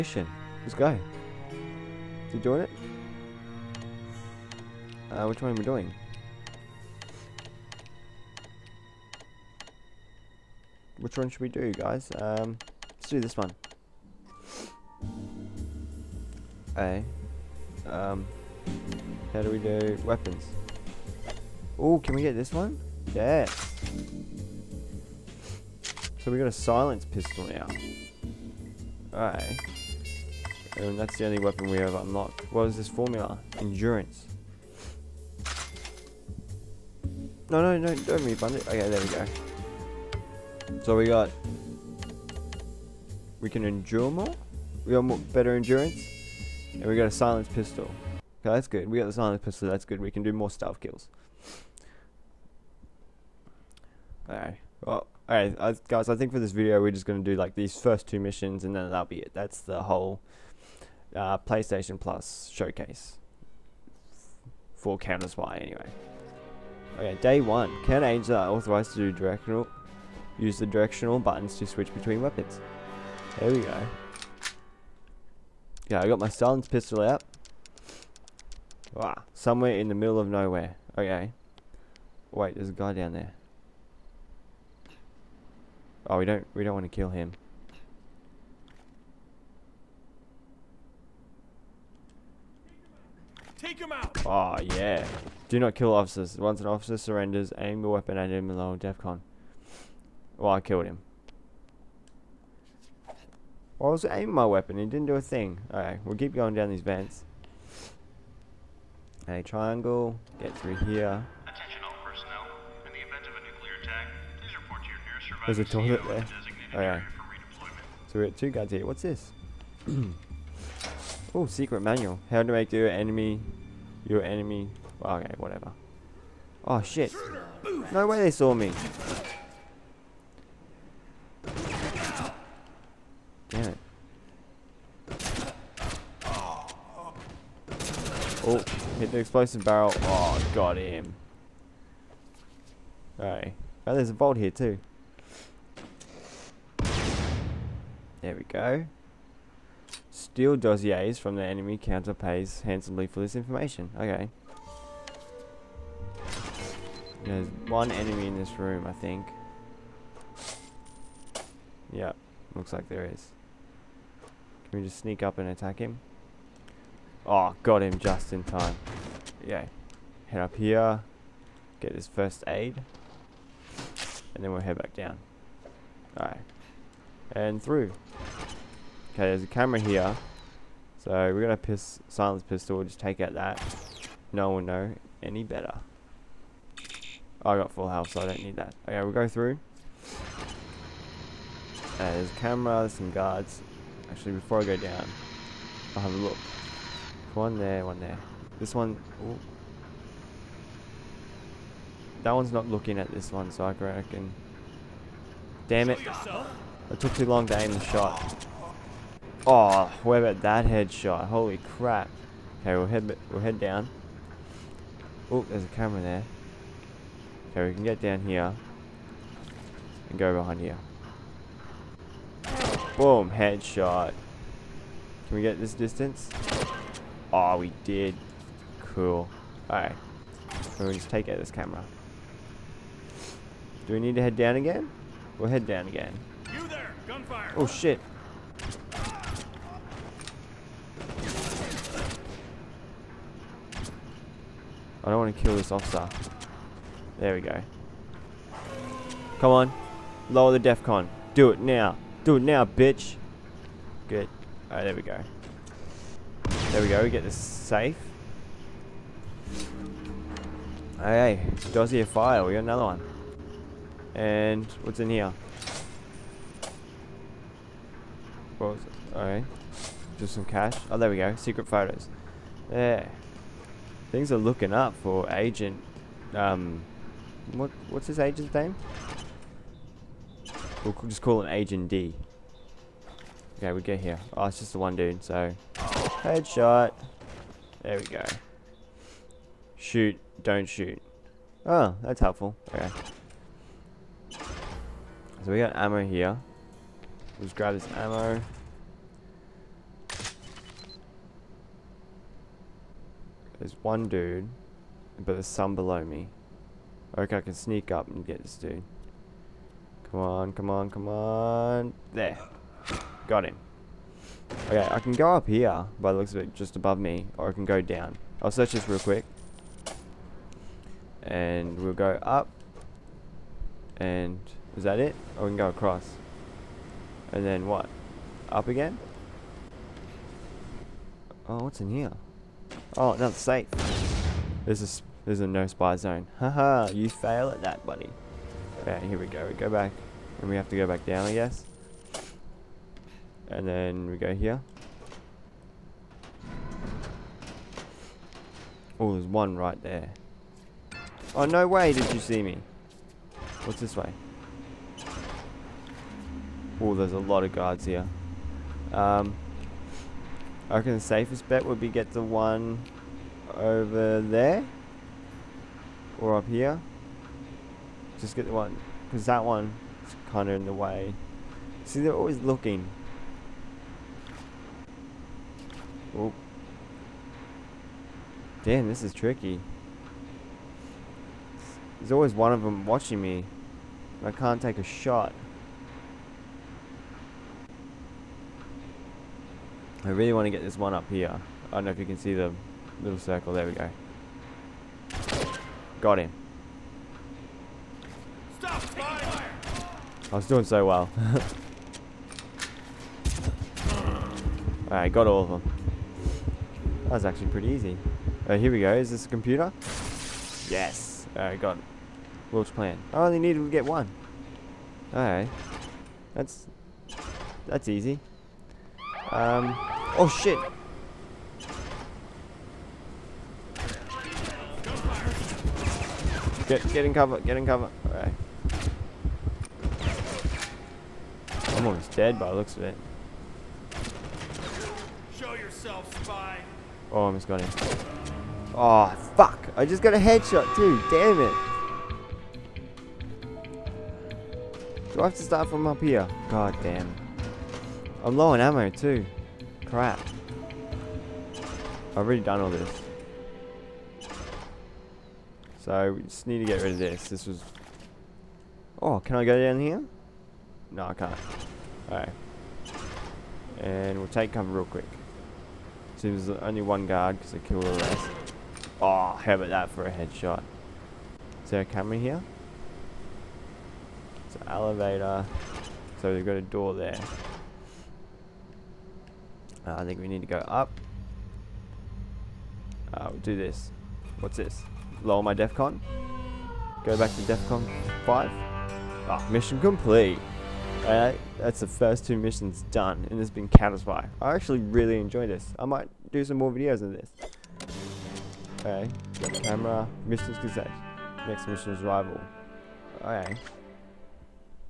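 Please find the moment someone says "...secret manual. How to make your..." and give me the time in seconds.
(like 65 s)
121 s.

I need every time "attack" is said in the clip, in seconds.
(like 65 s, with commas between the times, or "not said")
111 s, 165 s.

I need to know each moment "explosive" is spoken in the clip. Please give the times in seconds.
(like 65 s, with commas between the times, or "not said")
139 s.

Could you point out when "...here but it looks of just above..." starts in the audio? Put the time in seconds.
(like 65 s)
315 s.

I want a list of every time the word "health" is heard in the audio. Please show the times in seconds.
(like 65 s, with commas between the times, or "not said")
187 s.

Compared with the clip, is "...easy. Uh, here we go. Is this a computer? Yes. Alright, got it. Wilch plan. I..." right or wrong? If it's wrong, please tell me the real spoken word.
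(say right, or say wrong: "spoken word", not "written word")
right.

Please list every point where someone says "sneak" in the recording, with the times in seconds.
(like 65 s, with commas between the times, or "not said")
164 s, 307 s.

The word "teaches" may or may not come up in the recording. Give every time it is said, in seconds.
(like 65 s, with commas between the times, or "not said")
not said.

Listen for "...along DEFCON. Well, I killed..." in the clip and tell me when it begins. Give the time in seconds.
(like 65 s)
98 s.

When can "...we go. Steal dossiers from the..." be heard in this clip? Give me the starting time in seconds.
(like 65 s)
148 s.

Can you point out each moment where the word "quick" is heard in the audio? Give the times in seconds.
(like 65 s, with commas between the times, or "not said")
318 s, 464 s.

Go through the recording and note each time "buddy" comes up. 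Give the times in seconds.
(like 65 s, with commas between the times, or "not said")
337 s.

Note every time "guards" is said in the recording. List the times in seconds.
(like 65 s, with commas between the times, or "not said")
193 s, 357 s, 467 s.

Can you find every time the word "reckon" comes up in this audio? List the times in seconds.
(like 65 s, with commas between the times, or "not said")
203 s, 360 s.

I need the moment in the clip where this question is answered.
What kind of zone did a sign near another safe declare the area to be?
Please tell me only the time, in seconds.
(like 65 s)
335 s.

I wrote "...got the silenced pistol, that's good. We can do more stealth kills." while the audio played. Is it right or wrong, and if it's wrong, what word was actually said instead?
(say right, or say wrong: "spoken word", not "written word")
right.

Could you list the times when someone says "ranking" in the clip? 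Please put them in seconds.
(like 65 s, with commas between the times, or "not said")
not said.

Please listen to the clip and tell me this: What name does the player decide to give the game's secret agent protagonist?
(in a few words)
Agent D.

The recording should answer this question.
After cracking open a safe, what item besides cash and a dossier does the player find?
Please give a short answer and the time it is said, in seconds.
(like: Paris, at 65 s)
Secret photos, at 271 s.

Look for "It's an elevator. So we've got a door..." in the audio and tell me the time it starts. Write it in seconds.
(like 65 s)
474 s.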